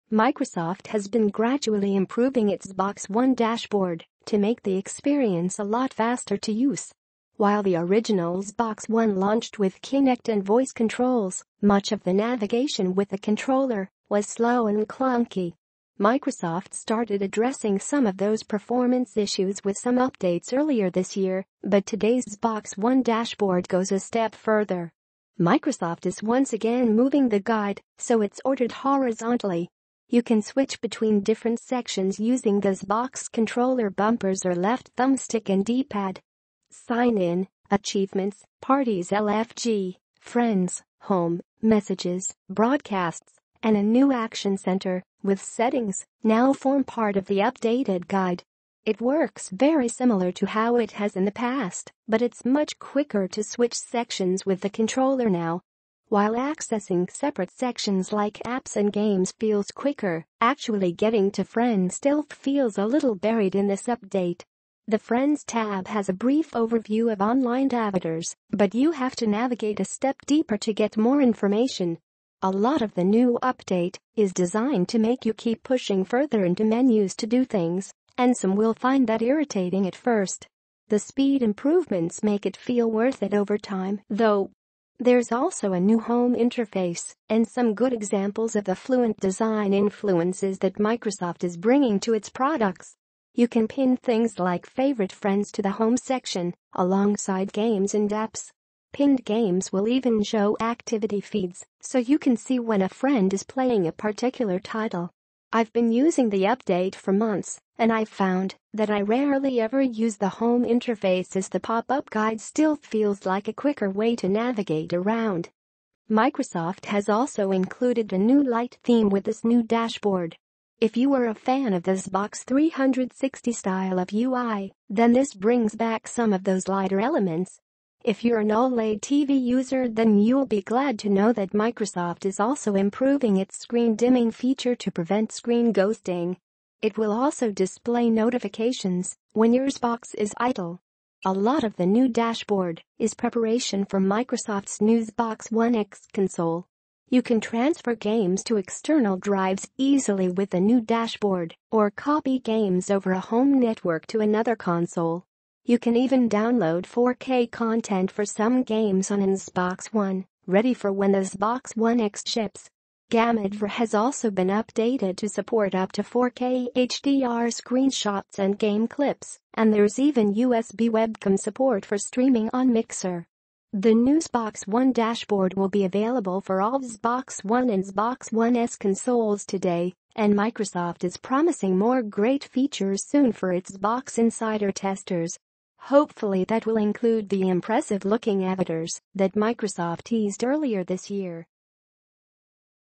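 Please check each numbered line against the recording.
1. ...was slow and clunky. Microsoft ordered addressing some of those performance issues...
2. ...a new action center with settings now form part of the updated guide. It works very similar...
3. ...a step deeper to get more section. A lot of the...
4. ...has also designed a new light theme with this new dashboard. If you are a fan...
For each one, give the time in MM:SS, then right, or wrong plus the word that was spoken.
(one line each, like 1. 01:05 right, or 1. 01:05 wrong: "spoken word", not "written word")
1. 00:14 wrong: "started", not "ordered"
2. 00:43 right
3. 01:09 wrong: "information", not "section"
4. 01:56 wrong: "included", not "designed".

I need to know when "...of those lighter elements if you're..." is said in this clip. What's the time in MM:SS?
02:06.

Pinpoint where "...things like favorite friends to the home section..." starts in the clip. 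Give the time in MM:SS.
01:33.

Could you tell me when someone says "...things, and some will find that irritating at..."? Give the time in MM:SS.
01:17.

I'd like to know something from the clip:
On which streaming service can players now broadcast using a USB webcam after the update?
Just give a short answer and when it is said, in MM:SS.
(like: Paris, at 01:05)
Mixer, at 02:52.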